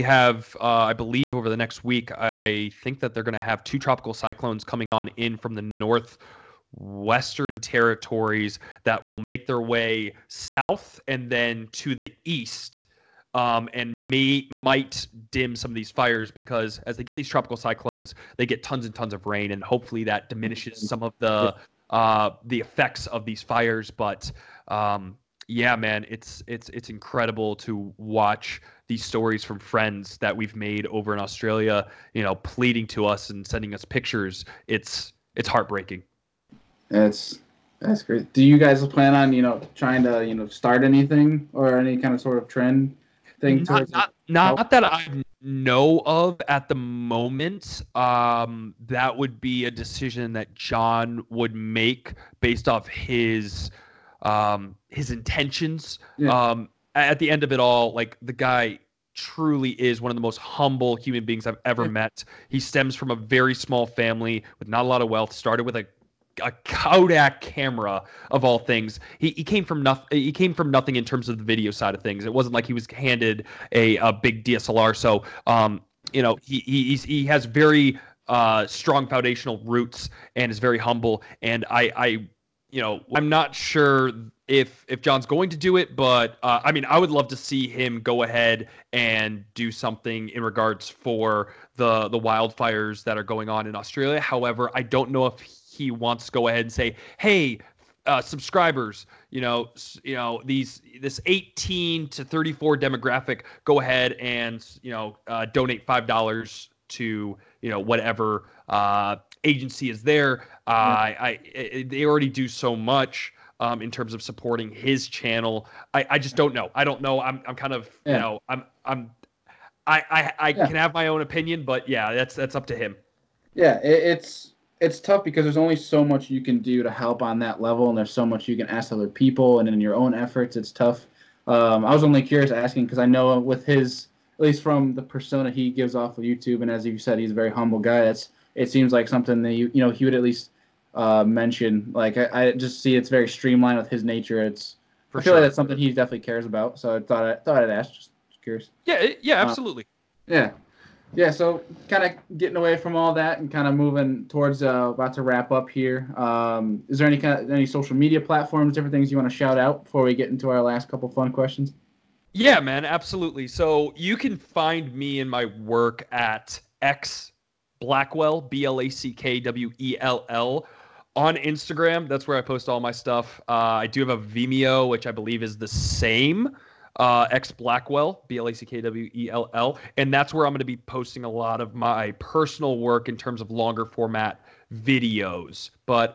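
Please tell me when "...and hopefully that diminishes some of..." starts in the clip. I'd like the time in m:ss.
0:19.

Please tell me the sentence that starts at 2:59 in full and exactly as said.
And that's where I'm going to be posting a lot of my personal work in terms of longer format videos.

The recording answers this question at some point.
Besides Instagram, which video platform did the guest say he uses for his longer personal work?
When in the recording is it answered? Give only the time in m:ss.
2:54.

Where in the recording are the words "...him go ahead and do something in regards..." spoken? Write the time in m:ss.
1:27.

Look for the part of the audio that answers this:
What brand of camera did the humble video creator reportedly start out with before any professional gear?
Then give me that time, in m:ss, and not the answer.
1:06.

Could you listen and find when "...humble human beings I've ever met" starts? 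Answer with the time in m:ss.
1:00.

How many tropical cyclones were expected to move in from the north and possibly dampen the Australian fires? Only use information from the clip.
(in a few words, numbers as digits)
2.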